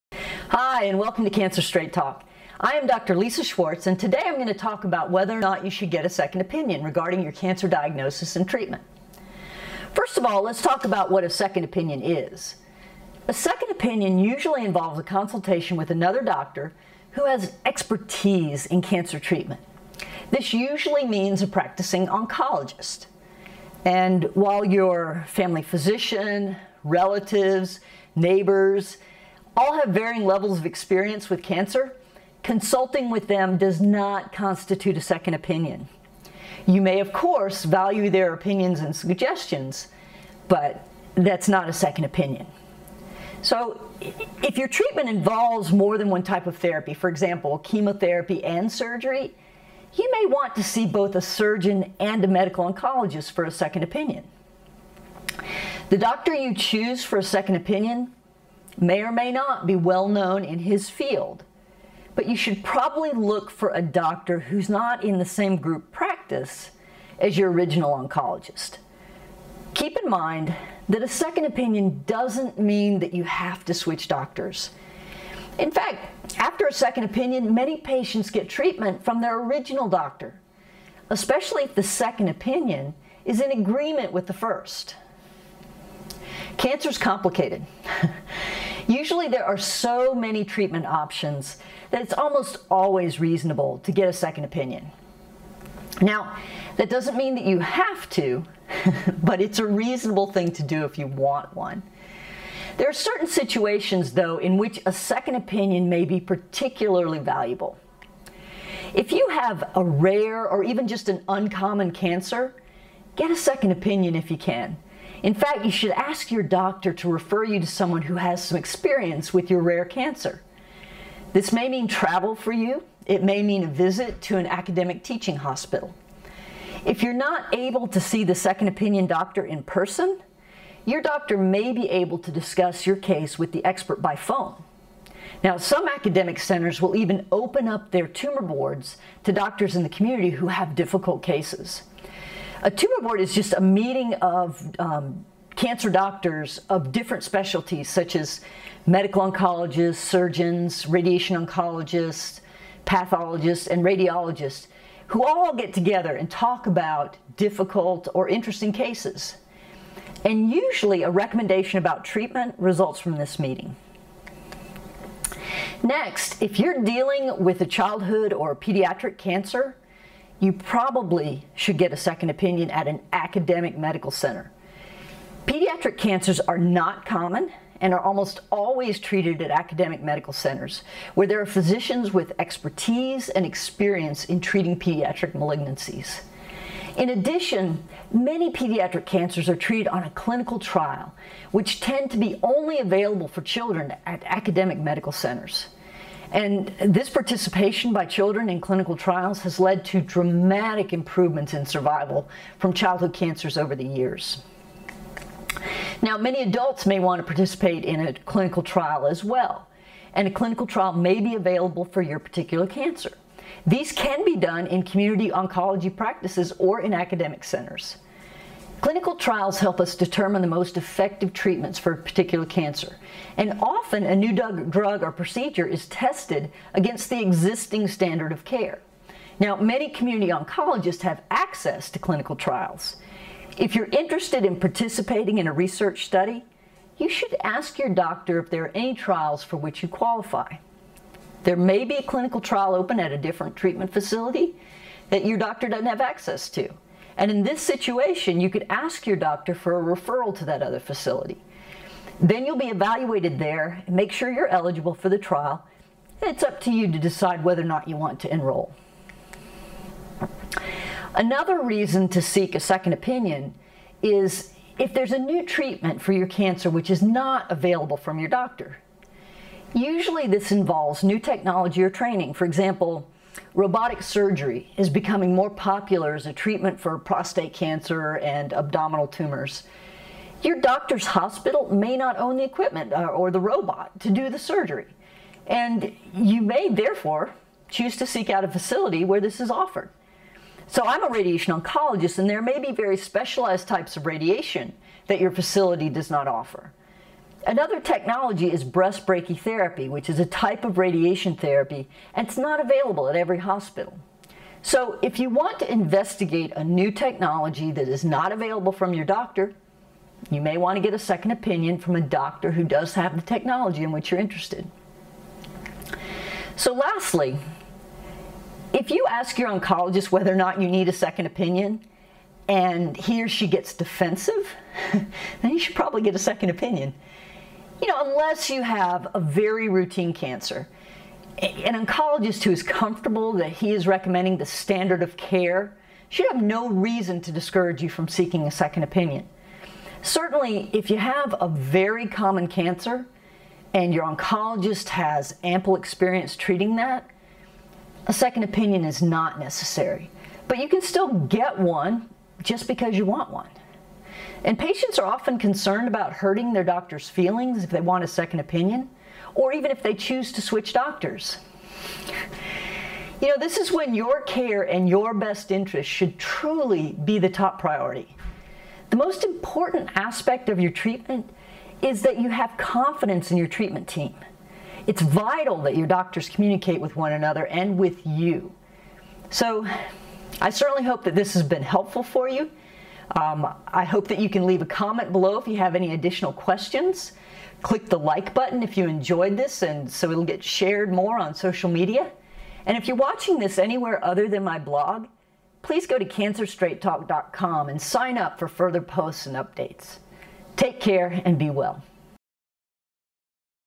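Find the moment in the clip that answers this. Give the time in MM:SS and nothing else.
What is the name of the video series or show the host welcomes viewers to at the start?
00:01.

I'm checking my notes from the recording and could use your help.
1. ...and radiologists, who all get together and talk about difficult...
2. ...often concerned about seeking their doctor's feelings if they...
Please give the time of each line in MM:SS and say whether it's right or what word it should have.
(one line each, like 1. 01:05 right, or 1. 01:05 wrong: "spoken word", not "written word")
1. 02:33 right
2. 05:55 wrong: "hurting", not "seeking".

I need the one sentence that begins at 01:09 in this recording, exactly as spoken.
Keep in mind that a second opinion doesn't mean that you have to switch doctors.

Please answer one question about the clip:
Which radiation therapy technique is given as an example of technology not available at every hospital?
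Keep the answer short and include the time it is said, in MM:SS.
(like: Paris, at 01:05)
breast brachytherapy, at 04:58.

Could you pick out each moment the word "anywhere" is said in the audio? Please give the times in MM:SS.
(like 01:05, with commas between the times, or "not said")
06:33.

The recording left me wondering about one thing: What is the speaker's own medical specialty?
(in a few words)
radiation oncologist.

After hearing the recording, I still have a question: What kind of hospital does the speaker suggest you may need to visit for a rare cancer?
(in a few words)
academic teaching hospital.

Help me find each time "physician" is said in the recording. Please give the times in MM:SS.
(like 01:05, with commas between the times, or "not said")
00:25, 03:01.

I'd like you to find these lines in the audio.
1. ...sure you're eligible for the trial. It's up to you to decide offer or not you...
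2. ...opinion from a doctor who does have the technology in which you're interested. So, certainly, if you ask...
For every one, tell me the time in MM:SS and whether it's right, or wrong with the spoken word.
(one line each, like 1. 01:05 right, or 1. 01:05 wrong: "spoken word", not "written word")
1. 04:14 wrong: "whether", not "offer"
2. 05:11 wrong: "lastly", not "certainly".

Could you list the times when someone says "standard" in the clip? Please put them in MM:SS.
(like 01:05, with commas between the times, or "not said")
03:47, 05:34.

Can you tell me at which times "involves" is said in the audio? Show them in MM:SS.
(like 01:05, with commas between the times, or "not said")
00:14, 00:45, 04:30.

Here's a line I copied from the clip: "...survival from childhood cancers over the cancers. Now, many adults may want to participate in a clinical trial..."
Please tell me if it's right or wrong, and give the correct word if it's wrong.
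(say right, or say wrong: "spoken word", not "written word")
wrong: "years", not "cancers".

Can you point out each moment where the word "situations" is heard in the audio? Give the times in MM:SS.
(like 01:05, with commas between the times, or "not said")
01:43, 04:07.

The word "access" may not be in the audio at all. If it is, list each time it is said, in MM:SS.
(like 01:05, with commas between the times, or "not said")
03:51, 04:06.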